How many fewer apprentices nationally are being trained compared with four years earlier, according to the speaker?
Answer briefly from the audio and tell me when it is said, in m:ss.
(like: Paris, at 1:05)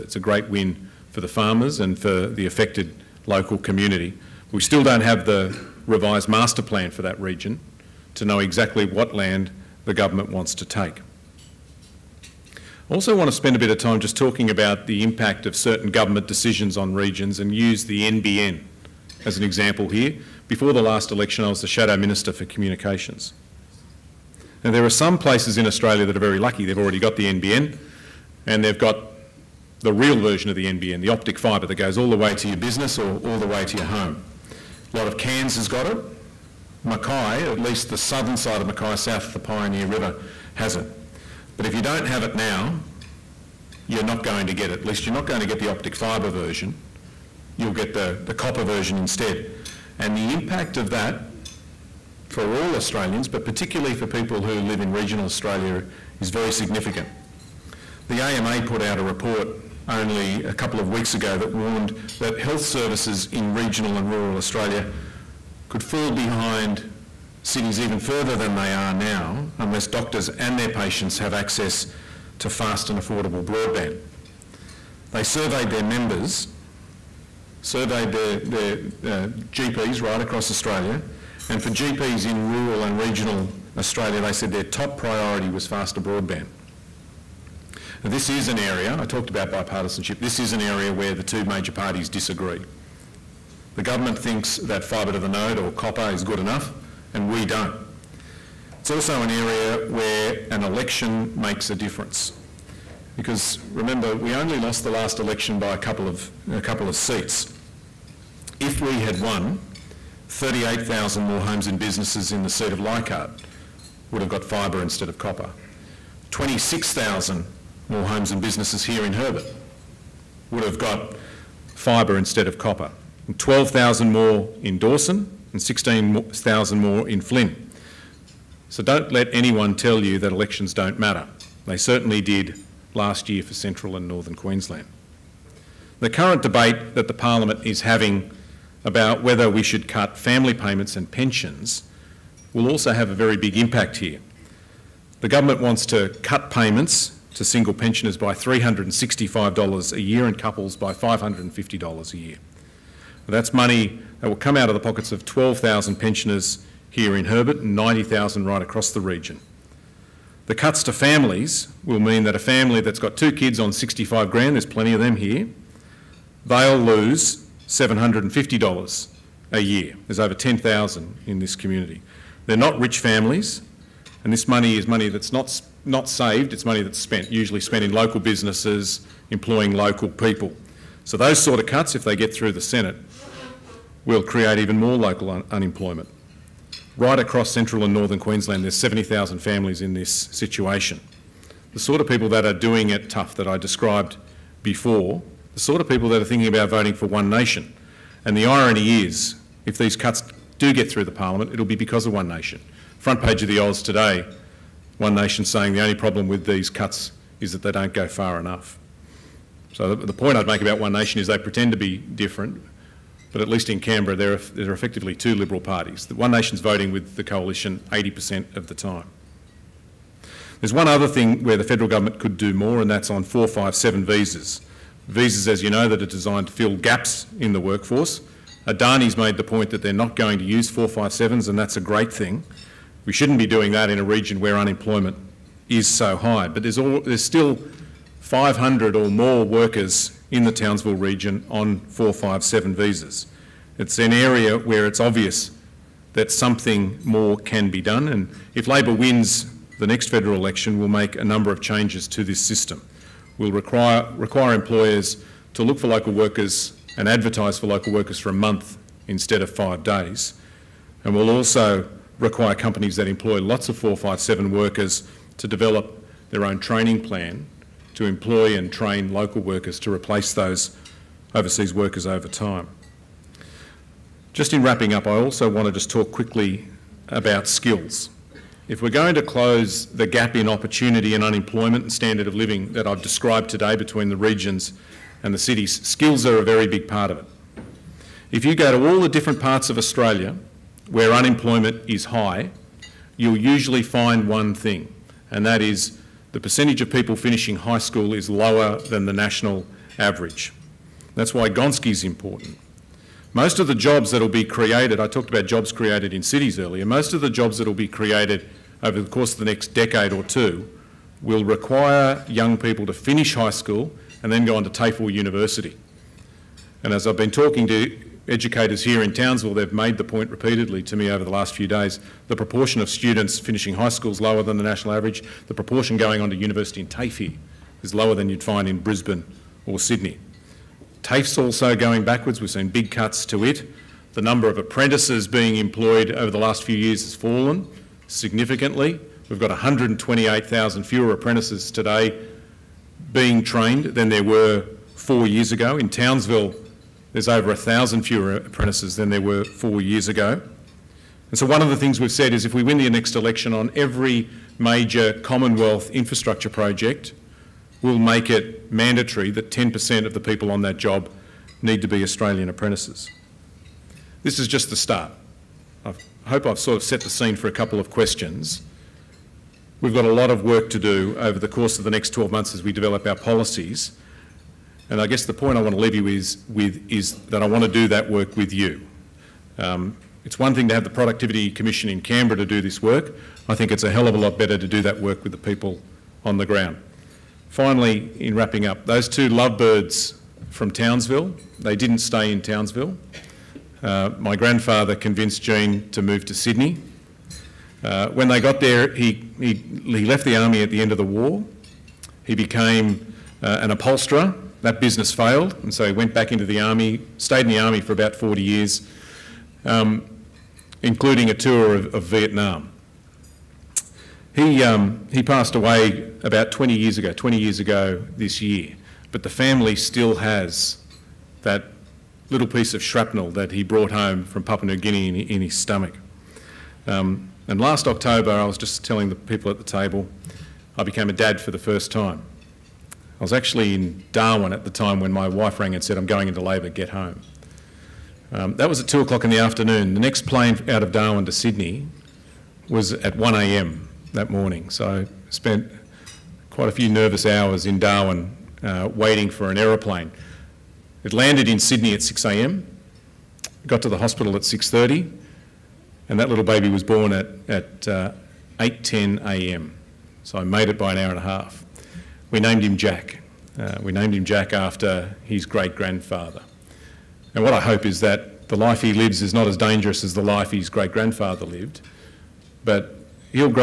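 128,000, at 5:39.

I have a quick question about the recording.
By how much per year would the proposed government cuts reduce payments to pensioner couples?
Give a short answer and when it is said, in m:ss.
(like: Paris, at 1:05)
$550, at 2:30.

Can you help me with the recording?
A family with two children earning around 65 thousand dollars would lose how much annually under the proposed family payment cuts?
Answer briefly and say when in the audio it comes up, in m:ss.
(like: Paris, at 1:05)
$750, at 2:47.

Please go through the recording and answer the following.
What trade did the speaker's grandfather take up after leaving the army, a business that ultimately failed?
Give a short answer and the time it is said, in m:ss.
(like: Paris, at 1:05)
upholsterer, at 6:43.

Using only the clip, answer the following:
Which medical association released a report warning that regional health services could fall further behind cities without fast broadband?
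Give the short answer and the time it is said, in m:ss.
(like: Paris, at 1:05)
AMA, at 0:58.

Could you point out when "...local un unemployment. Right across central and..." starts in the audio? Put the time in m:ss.
3:04.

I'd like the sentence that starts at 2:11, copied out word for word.
They certainly did last year for Central and Northern Queensland.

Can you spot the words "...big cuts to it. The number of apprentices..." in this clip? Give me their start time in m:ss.
5:32.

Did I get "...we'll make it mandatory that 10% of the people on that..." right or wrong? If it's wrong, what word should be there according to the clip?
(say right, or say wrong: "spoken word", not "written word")
right.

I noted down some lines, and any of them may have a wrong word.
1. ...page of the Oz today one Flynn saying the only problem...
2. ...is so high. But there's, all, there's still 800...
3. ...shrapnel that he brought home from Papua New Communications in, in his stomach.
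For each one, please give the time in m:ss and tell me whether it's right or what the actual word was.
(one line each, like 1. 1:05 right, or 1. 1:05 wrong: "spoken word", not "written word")
1. 3:23 wrong: "Nation", not "Flynn"
2. 3:55 wrong: "500", not "800"
3. 7:02 wrong: "Guinea", not "Communications".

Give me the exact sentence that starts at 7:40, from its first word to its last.
So I made it by an hour and a half we named him Jack.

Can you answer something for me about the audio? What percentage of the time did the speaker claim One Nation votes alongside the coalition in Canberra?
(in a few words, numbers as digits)
80%.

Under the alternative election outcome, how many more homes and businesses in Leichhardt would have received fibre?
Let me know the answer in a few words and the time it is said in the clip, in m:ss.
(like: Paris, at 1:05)
38,000, at 1:50.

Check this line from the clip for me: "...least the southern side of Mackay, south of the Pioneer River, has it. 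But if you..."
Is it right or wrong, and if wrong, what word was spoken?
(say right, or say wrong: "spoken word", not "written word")
right.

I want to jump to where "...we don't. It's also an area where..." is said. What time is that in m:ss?
1:37.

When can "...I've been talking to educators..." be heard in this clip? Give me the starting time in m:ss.
5:17.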